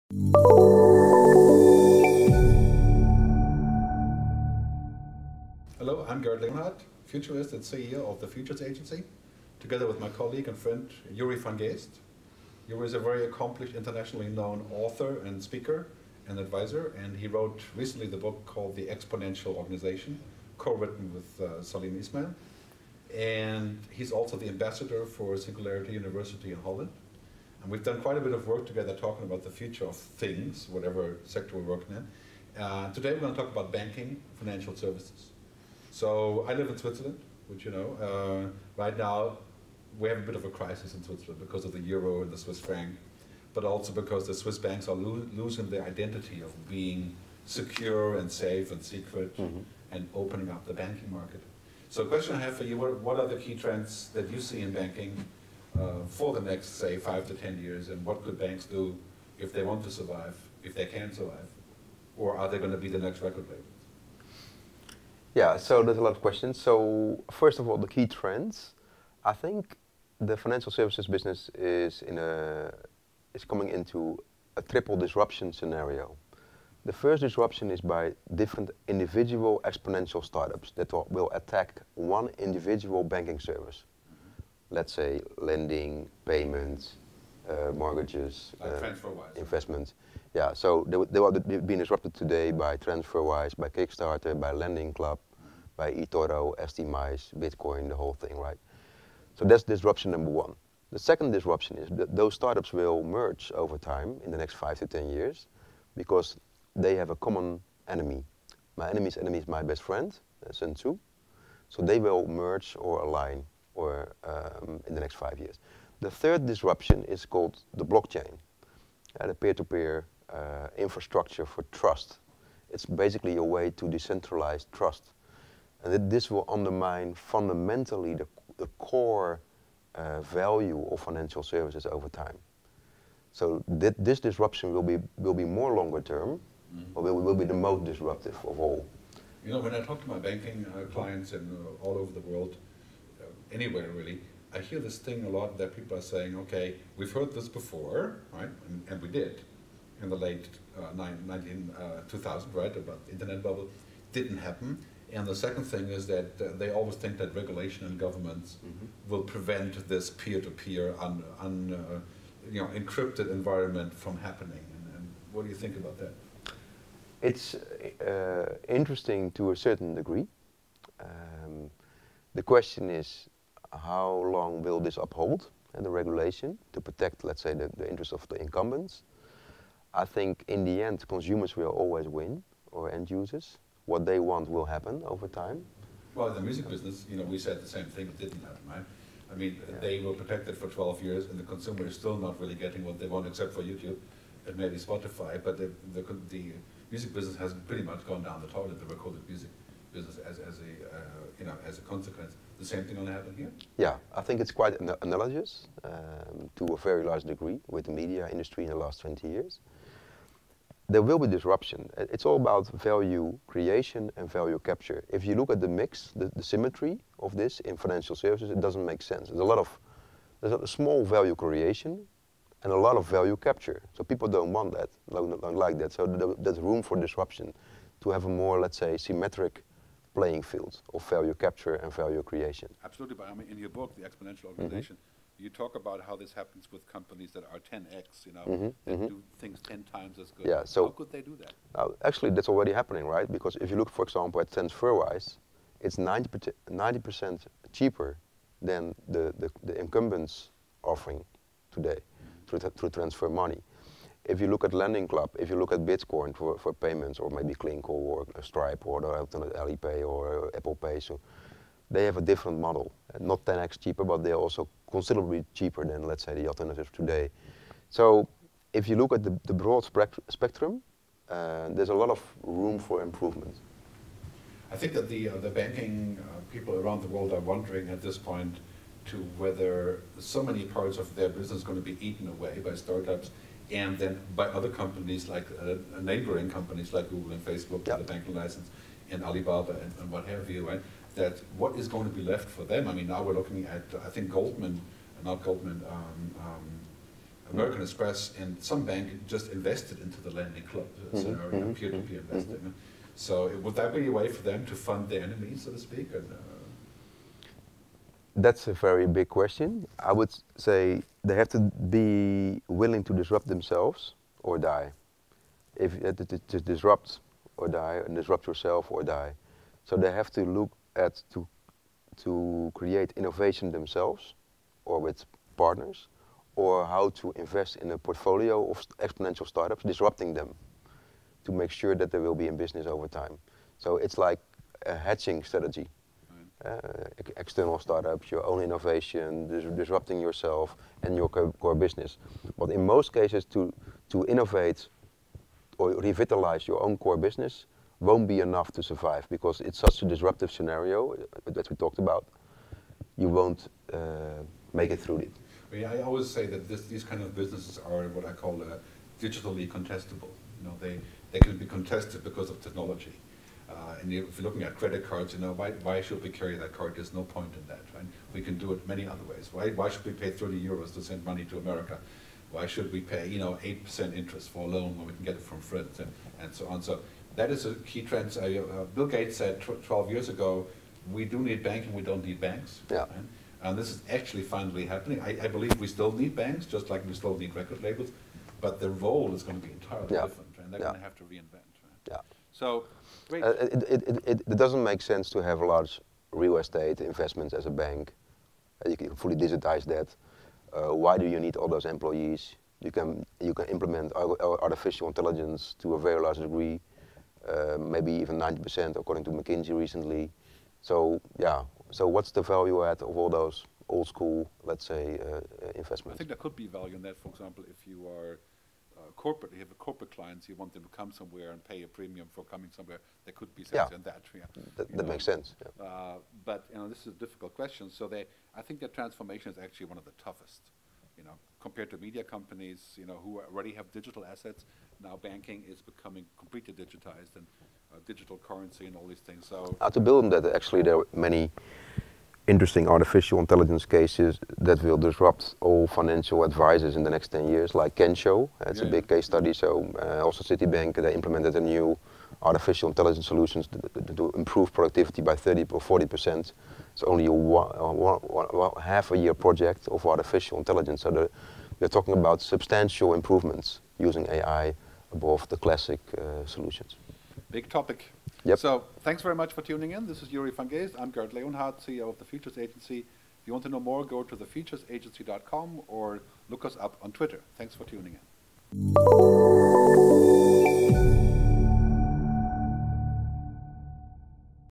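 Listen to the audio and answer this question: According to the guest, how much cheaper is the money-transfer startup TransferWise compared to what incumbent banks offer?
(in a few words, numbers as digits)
90 percent.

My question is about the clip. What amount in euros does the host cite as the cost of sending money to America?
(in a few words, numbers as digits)
30 euros.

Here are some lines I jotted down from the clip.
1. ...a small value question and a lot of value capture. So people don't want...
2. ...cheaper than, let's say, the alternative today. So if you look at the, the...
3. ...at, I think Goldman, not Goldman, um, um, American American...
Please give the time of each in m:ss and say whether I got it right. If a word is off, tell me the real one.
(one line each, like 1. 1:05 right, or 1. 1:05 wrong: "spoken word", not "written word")
1. 3:40 wrong: "creation", not "question"
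2. 4:25 right
3. 4:53 wrong: "Express", not "American".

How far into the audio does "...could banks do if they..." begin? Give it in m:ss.
0:58.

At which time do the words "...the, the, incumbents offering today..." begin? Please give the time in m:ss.
4:09.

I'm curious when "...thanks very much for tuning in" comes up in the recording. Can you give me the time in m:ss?
7:49.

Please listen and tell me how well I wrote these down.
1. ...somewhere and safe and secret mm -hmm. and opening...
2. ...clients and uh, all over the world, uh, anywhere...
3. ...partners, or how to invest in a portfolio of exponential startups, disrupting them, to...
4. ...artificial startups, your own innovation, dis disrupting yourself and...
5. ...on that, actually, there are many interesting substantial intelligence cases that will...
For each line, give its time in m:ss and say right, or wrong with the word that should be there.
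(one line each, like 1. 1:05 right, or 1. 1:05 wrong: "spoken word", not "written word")
1. 0:47 wrong: "secure", not "somewhere"
2. 2:20 right
3. 5:25 right
4. 5:37 wrong: "external", not "artificial"
5. 7:20 wrong: "artificial", not "substantial".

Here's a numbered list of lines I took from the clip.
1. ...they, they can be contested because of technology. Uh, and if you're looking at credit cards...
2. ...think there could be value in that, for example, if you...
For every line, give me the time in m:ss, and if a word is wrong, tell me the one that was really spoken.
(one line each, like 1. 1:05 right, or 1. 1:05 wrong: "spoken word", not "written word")
1. 6:00 right
2. 6:56 right.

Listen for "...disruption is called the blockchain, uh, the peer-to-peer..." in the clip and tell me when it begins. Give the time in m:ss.
1:56.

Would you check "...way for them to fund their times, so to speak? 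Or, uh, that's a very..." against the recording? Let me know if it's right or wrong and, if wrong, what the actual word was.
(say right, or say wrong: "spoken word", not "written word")
wrong: "enemies", not "times".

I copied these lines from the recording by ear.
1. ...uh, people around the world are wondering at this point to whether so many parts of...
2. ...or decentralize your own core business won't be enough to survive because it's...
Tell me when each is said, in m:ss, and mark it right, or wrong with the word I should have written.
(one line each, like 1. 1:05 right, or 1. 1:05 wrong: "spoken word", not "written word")
1. 4:36 right
2. 5:45 wrong: "revitalize", not "decentralize".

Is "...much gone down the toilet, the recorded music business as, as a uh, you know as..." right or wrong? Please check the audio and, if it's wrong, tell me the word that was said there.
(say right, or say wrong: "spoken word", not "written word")
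right.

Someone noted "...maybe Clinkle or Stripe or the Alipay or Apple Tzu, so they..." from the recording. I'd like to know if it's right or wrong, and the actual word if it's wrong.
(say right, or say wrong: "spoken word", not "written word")
wrong: "Pay", not "Tzu".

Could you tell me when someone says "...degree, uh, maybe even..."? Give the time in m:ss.
6:46.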